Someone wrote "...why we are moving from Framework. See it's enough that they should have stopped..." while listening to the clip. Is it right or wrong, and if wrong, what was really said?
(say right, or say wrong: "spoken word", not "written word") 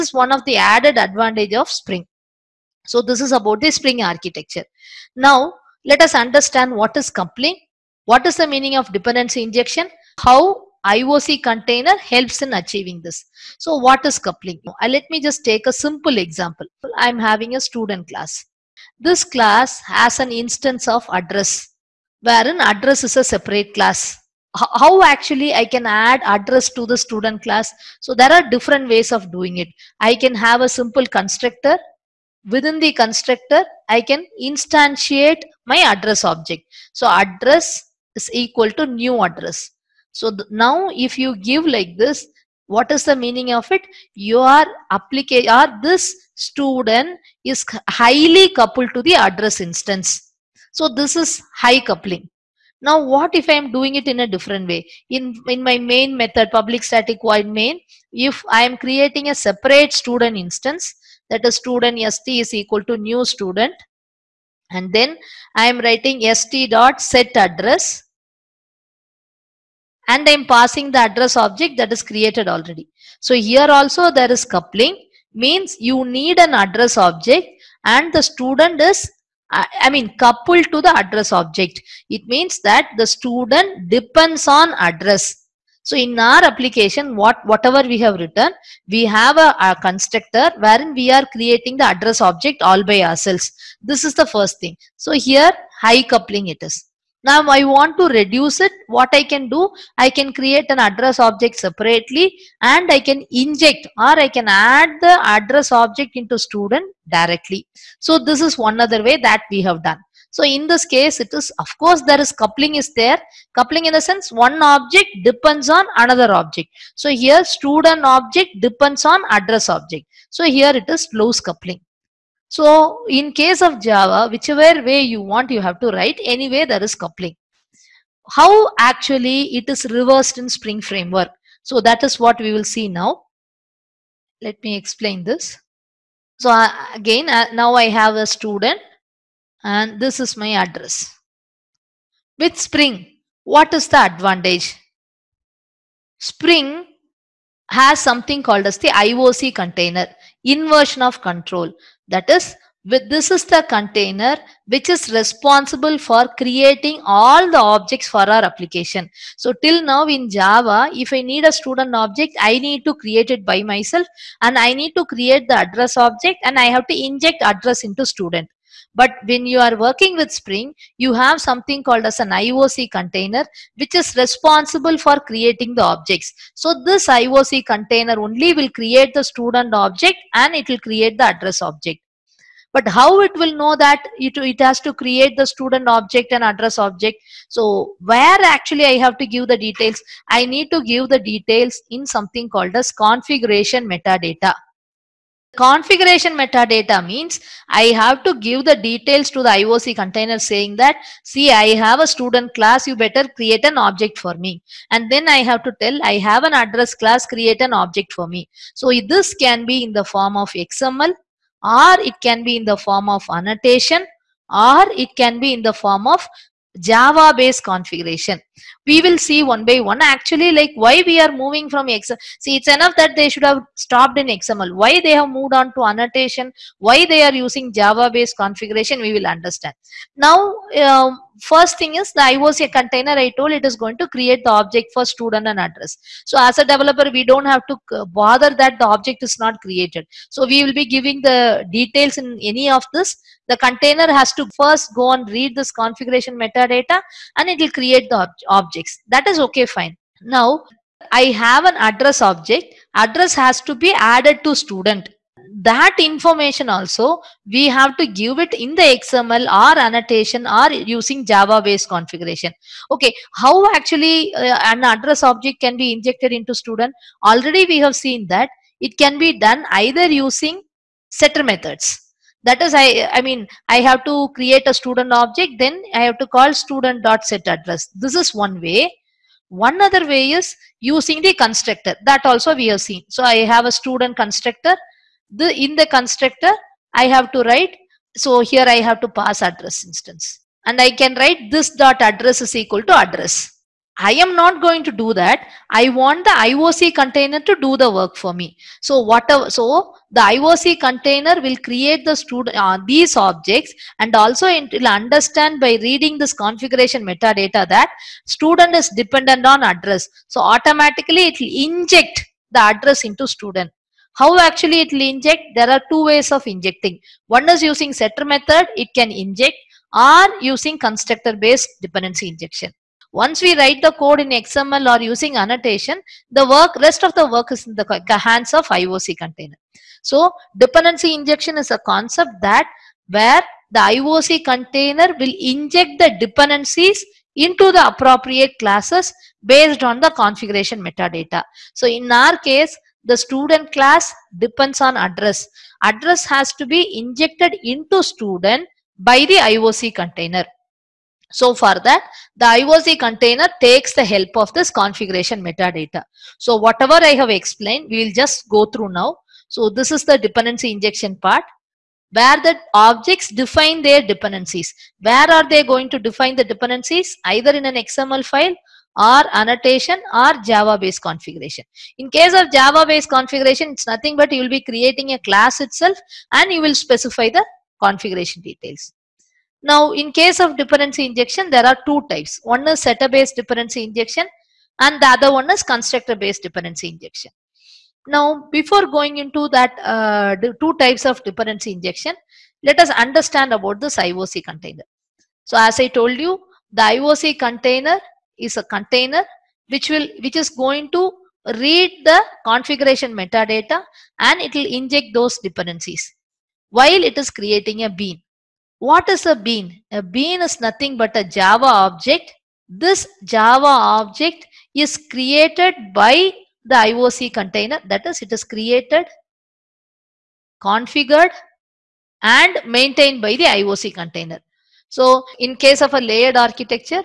wrong: "XML", not "Framework".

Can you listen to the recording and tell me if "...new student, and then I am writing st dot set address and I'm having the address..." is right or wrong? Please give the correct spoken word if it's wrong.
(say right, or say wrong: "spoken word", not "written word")
wrong: "passing", not "having".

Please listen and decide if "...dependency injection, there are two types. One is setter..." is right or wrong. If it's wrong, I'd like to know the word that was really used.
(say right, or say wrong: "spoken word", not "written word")
right.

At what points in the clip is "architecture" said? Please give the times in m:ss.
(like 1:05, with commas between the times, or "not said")
0:04, 7:06.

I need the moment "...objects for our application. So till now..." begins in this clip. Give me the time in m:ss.
2:37.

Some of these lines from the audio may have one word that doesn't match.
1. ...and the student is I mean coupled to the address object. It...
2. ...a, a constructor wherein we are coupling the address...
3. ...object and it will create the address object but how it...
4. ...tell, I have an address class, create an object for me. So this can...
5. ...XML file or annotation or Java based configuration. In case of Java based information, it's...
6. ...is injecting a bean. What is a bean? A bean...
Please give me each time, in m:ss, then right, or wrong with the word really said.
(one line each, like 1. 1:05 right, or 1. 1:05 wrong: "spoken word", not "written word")
1. 1:17 right
2. 1:29 wrong: "creating", not "coupling"
3. 2:59 right
4. 3:25 right
5. 6:07 wrong: "configuration", not "information"
6. 6:47 wrong: "creating", not "injecting".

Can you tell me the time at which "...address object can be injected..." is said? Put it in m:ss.
4:24.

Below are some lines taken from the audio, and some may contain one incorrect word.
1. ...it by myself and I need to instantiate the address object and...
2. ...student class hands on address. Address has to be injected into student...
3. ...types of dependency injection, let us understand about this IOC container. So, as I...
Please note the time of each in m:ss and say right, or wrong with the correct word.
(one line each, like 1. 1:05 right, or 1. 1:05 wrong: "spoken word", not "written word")
1. 2:43 wrong: "create", not "instantiate"
2. 5:43 wrong: "depends", not "hands"
3. 6:30 right.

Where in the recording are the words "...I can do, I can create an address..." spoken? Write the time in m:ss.
1:39.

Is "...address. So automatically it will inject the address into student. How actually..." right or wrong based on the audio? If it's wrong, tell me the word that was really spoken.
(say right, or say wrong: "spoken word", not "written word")
right.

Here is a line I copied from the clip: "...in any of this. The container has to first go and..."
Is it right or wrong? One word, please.
right.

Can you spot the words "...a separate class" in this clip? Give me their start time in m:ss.
0:23.